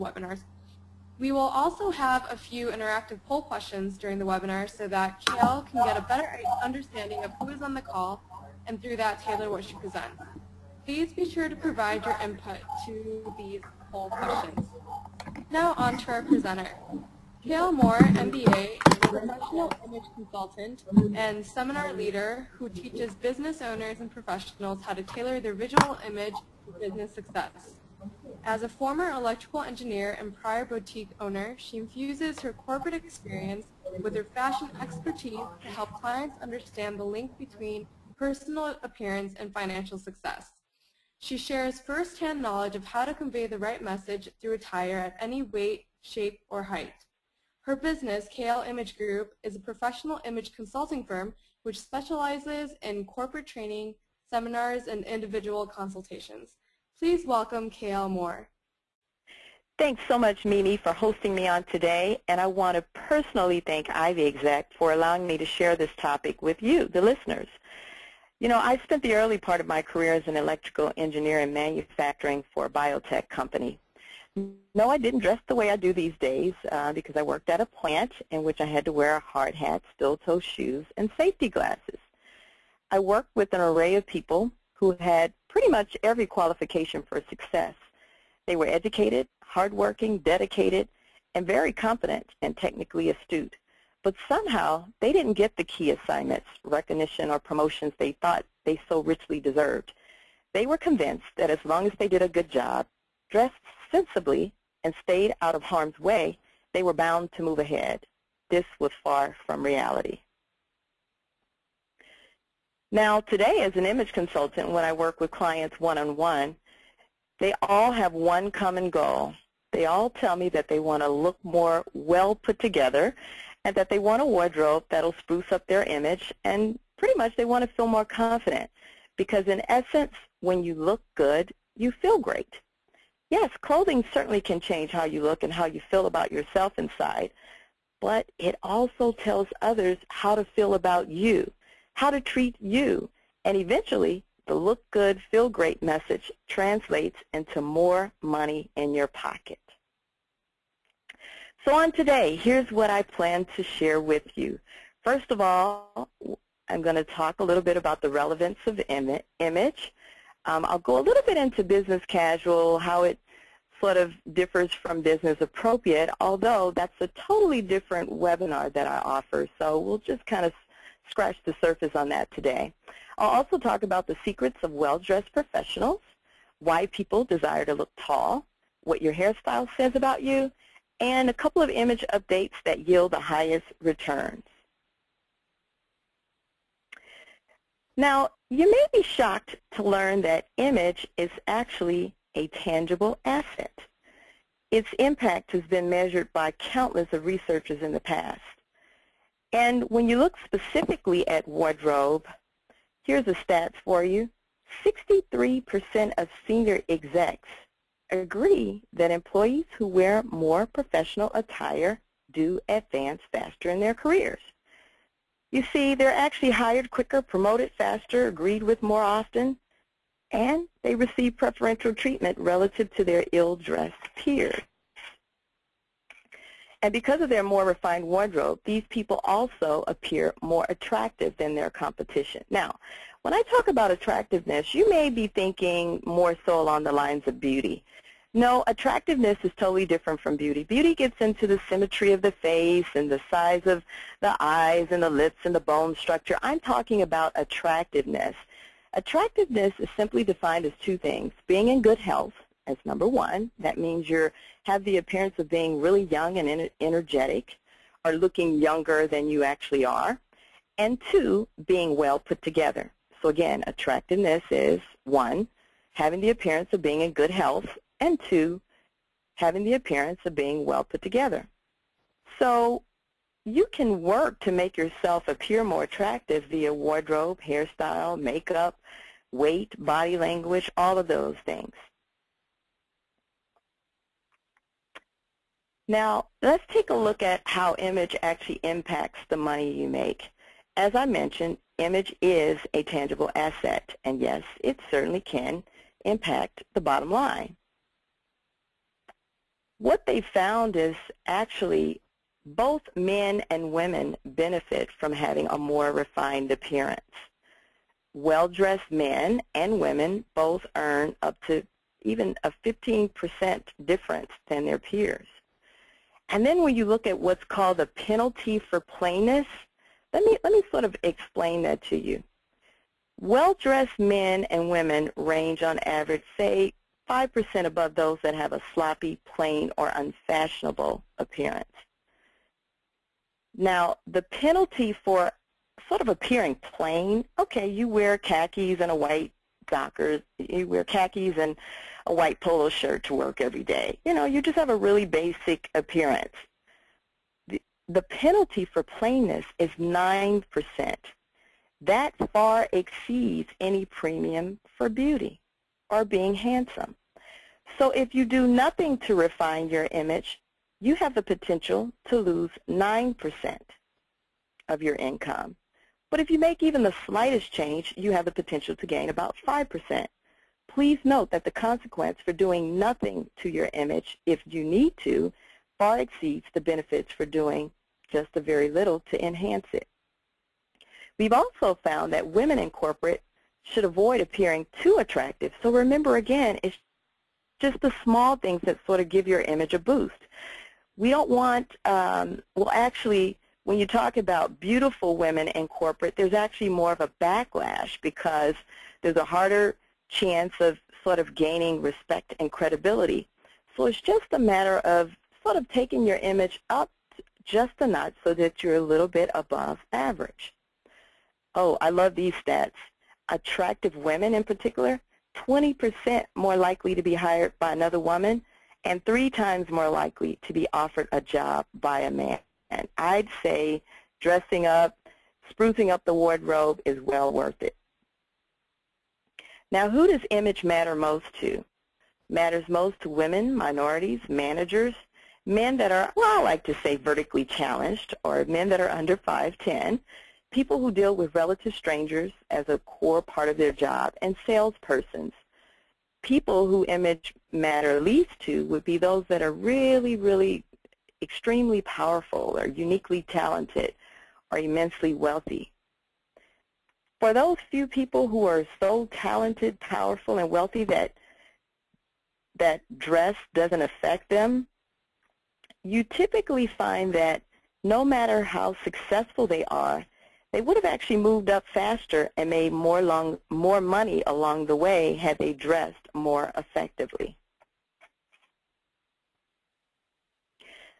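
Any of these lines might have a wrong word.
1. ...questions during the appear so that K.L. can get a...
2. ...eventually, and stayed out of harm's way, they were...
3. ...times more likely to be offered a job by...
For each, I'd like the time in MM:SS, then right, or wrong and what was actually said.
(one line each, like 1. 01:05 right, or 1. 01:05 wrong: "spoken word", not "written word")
1. 00:03 wrong: "webinar", not "appear"
2. 01:43 wrong: "sensibly", not "eventually"
3. 06:59 right.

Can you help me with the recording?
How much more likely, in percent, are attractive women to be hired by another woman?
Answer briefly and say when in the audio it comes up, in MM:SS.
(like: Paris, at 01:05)
20%, at 06:55.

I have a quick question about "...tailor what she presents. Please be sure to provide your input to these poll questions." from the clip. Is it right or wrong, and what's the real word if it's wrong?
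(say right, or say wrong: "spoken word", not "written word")
right.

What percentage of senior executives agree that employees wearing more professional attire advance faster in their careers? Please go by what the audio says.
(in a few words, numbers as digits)
63%.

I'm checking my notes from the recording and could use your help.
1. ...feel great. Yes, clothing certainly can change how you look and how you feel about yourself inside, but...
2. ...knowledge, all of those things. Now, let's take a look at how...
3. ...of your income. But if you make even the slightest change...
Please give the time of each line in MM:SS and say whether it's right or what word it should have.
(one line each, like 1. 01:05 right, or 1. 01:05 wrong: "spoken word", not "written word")
1. 02:11 right
2. 04:40 wrong: "language", not "knowledge"
3. 06:04 right.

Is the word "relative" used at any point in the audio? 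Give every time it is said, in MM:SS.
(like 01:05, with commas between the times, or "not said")
03:42, 07:21.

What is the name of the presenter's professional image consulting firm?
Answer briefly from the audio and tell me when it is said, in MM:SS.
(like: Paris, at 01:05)
KL Image Group, at 00:48.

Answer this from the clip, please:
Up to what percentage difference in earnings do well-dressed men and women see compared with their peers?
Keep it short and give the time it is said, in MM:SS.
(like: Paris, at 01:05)
15%, at 05:12.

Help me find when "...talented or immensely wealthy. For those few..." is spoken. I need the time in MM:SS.
07:33.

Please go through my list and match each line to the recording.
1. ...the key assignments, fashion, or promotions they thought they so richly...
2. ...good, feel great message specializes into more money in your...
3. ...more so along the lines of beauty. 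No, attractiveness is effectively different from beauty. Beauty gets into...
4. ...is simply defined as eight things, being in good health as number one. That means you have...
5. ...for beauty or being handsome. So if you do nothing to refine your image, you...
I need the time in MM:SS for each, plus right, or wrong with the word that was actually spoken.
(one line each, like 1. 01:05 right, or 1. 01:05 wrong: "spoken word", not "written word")
1. 01:35 wrong: "recognition", not "fashion"
2. 02:24 wrong: "translates", not "specializes"
3. 03:56 wrong: "totally", not "effectively"
4. 04:09 wrong: "two", not "eight"
5. 05:54 right.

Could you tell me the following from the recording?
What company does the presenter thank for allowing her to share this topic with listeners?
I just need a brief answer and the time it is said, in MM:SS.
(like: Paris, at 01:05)
Ivy Exec, at 01:03.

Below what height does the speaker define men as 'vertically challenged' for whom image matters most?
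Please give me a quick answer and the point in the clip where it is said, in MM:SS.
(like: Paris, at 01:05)
5'10", at 07:19.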